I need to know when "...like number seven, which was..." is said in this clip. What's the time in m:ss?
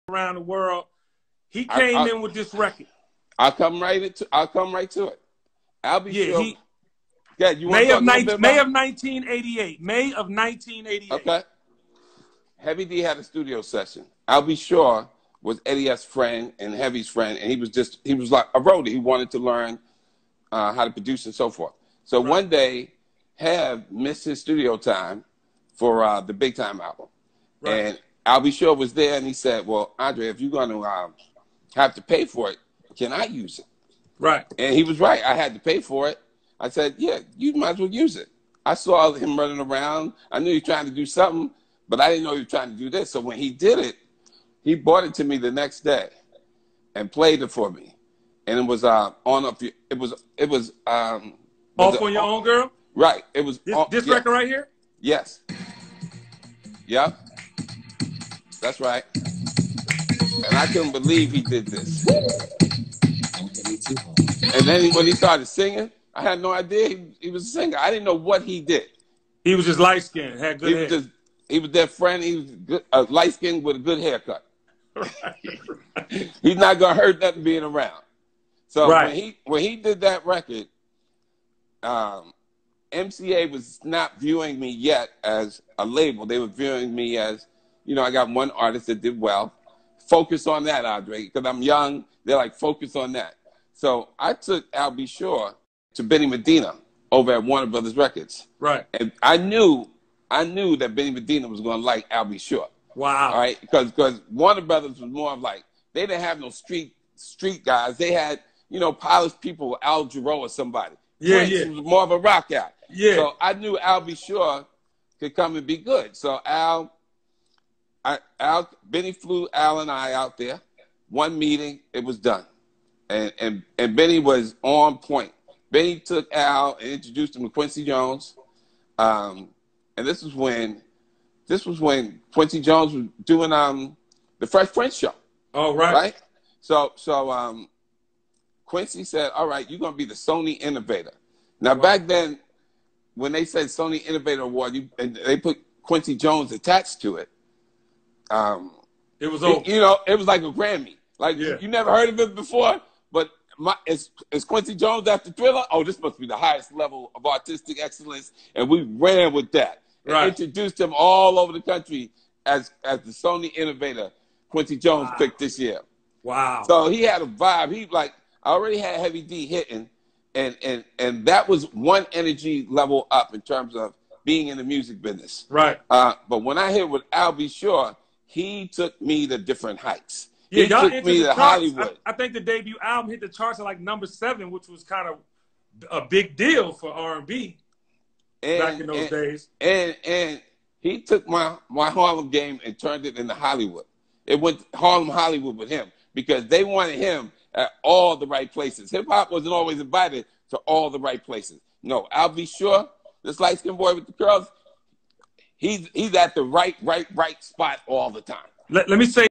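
3:03.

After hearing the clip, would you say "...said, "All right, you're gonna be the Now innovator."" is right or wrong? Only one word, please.
wrong.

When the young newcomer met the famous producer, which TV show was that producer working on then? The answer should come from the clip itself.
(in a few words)
The Fresh Prince.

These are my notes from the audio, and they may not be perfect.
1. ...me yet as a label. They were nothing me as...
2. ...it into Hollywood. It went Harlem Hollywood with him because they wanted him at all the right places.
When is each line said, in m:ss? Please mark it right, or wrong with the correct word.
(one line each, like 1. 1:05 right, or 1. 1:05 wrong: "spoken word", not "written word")
1. 1:24 wrong: "viewing", not "nothing"
2. 3:13 right.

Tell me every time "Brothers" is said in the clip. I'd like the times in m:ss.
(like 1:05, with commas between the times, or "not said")
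1:37, 1:44.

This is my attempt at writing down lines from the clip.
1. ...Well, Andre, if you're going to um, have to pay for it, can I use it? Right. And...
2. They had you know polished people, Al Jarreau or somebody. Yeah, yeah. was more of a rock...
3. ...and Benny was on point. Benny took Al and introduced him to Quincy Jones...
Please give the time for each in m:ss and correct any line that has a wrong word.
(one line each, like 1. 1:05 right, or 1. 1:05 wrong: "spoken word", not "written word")
1. 0:29 right
2. 1:47 right
3. 2:03 right.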